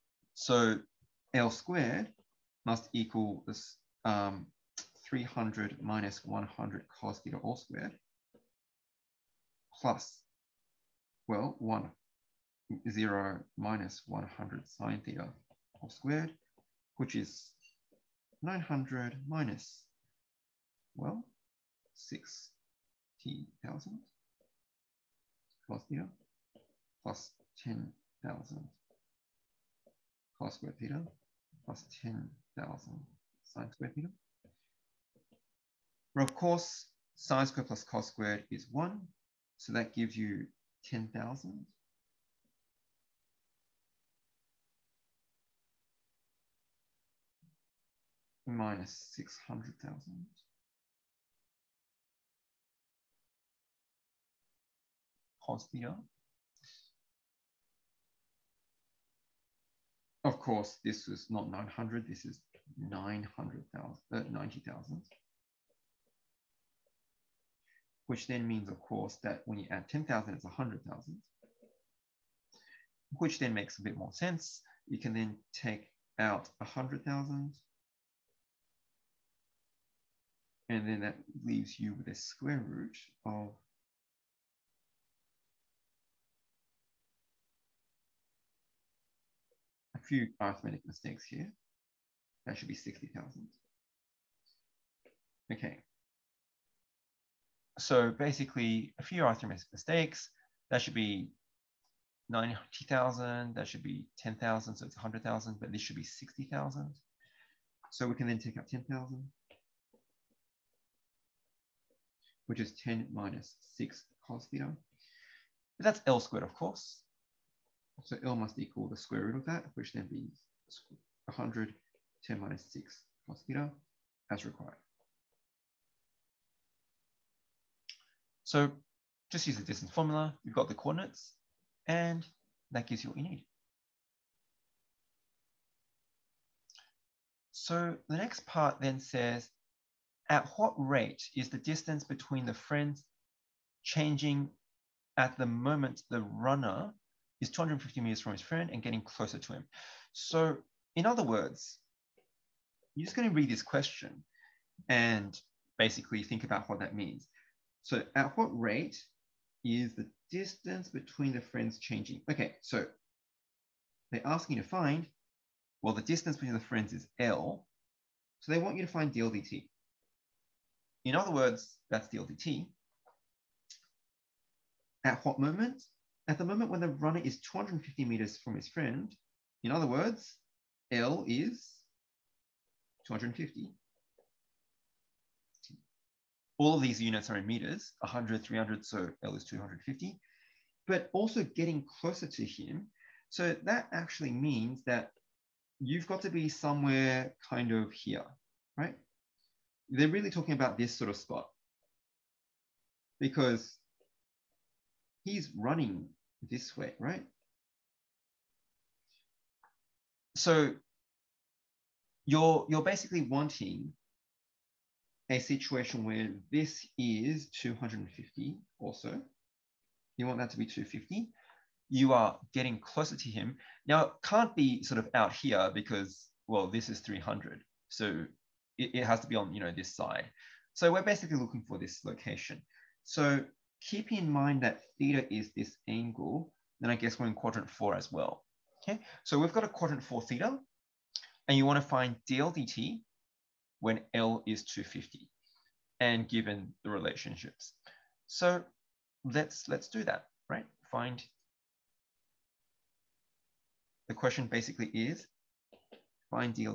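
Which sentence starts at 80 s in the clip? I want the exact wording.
And then that leaves you with a square root of few arithmetic mistakes here.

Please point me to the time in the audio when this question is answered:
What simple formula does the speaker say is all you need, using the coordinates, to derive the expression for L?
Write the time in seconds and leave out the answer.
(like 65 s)
129 s.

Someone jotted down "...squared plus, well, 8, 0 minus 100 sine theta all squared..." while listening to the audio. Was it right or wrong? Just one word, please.
wrong.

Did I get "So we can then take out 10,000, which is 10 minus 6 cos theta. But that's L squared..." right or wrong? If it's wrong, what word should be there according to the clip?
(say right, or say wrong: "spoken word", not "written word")
right.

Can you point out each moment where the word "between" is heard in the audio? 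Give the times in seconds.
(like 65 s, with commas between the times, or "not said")
142 s, 160 s, 166 s.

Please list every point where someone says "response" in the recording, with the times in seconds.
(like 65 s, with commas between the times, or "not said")
not said.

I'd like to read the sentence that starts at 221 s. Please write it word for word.
You are getting closer to him.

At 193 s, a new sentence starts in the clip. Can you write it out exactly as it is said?
So that actually means that you've got to be somewhere kind of here, right?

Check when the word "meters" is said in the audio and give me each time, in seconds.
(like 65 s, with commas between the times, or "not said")
33 s, 148 s, 178 s, 187 s.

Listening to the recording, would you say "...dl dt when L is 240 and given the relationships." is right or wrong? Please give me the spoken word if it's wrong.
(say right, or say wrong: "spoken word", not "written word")
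wrong: "250", not "240".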